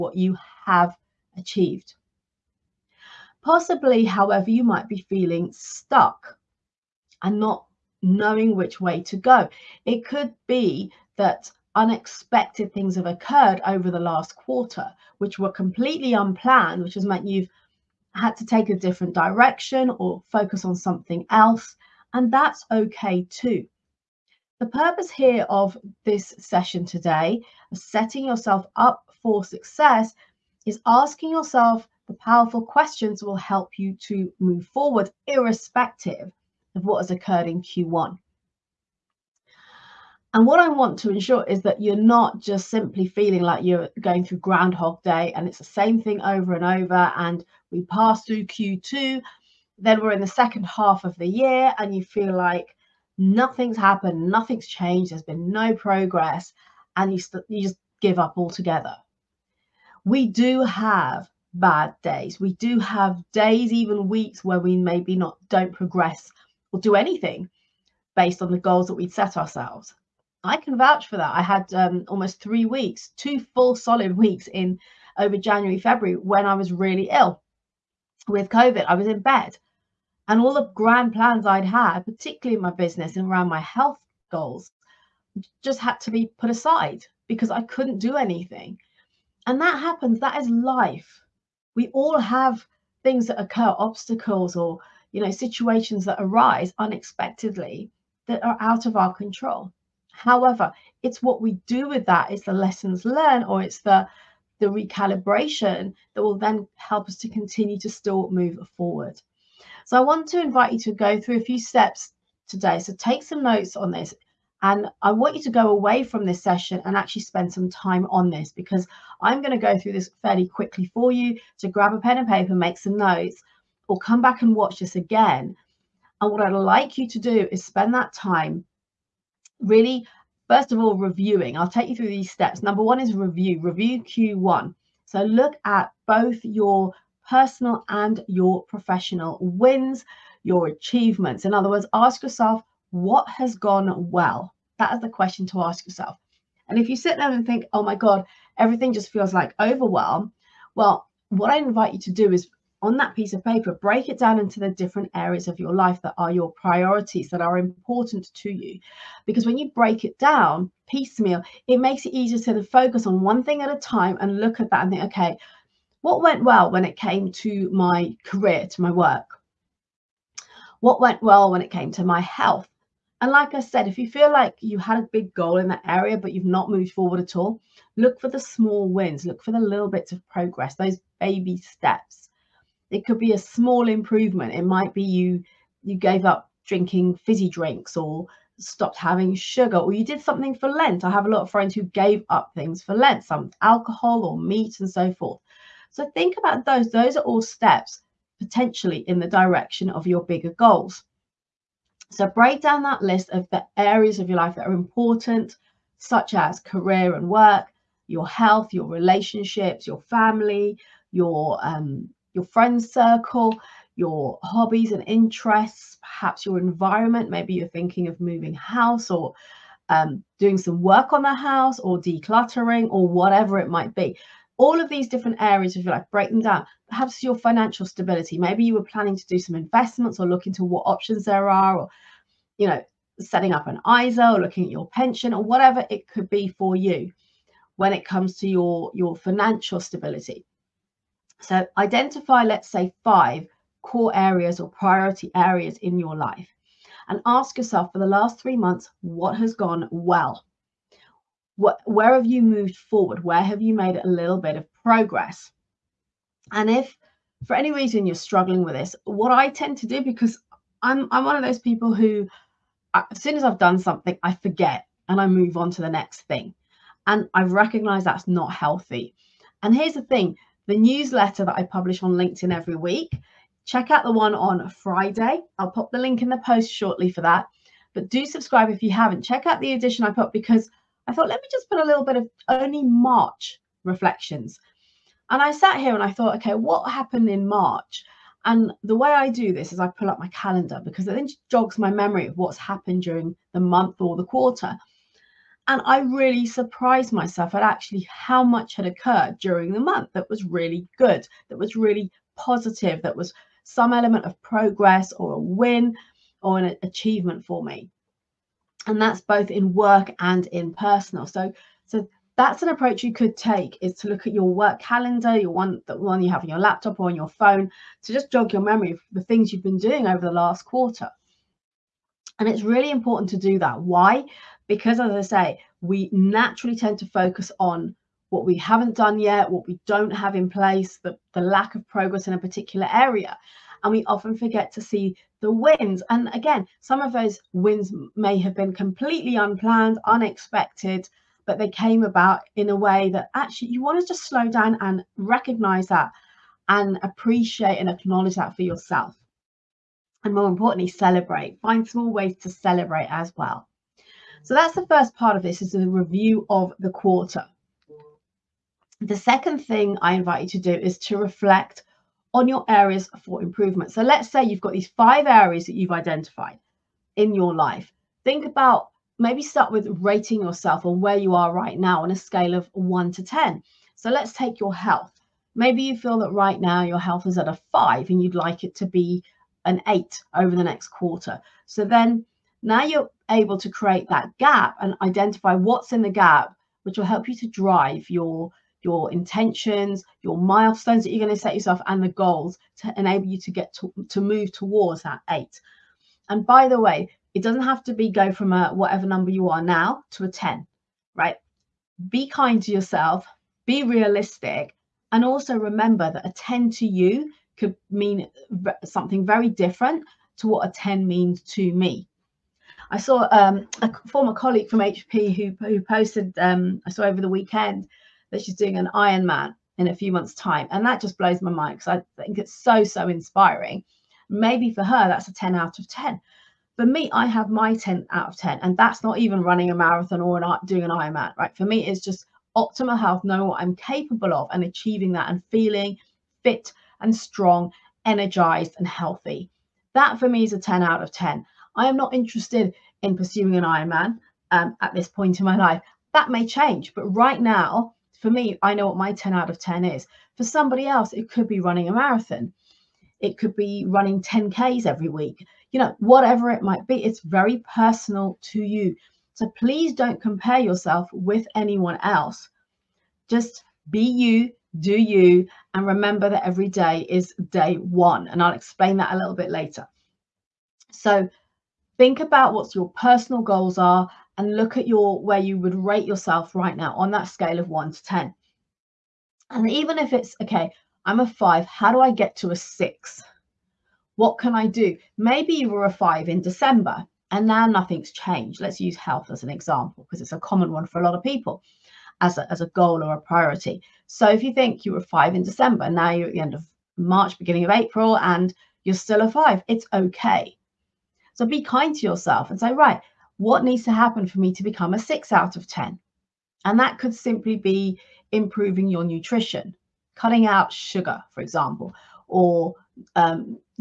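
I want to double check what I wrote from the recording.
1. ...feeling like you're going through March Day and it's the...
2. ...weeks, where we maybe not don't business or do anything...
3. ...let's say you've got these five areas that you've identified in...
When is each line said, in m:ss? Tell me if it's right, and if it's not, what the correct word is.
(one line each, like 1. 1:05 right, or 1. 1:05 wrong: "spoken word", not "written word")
1. 0:43 wrong: "Groundhog", not "March"
2. 1:04 wrong: "progress", not "business"
3. 6:04 right.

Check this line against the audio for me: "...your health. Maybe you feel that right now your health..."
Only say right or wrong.
right.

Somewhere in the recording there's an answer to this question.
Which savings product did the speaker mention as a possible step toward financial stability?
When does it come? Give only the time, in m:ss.
3:54.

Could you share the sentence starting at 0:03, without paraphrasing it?
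Possibly, however, you might be feeling stuck and not knowing which way to go.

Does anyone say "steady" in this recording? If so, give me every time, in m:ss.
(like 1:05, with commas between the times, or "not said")
not said.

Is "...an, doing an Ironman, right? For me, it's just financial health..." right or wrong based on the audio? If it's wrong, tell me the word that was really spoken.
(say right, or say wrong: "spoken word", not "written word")
wrong: "optimal", not "financial".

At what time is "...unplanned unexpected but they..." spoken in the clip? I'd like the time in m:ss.
5:39.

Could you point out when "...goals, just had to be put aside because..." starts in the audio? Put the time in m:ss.
1:24.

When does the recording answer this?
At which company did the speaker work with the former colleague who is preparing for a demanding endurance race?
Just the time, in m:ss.
6:54.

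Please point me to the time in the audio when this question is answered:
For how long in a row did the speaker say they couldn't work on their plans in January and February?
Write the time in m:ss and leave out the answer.
1:13.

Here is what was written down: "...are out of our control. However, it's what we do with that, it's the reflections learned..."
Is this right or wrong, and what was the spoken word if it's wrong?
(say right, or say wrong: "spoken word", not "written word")
wrong: "lessons", not "reflections".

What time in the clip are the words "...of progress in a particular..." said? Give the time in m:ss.
5:31.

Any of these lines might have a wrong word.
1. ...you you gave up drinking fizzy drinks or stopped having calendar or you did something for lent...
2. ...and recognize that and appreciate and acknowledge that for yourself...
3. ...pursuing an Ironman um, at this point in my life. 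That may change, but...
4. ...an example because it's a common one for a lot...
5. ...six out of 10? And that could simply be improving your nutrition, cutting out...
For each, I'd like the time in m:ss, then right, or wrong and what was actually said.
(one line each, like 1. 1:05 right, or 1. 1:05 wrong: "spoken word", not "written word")
1. 3:05 wrong: "sugar", not "calendar"
2. 5:44 right
3. 7:23 right
4. 8:09 right
5. 8:24 right.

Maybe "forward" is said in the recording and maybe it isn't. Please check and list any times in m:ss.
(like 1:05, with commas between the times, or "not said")
0:34, 1:48, 2:56, 4:12.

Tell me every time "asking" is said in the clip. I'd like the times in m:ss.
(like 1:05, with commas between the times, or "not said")
0:30.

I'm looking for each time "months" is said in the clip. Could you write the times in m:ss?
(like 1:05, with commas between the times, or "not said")
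4:08, 4:53, 4:59, 7:00.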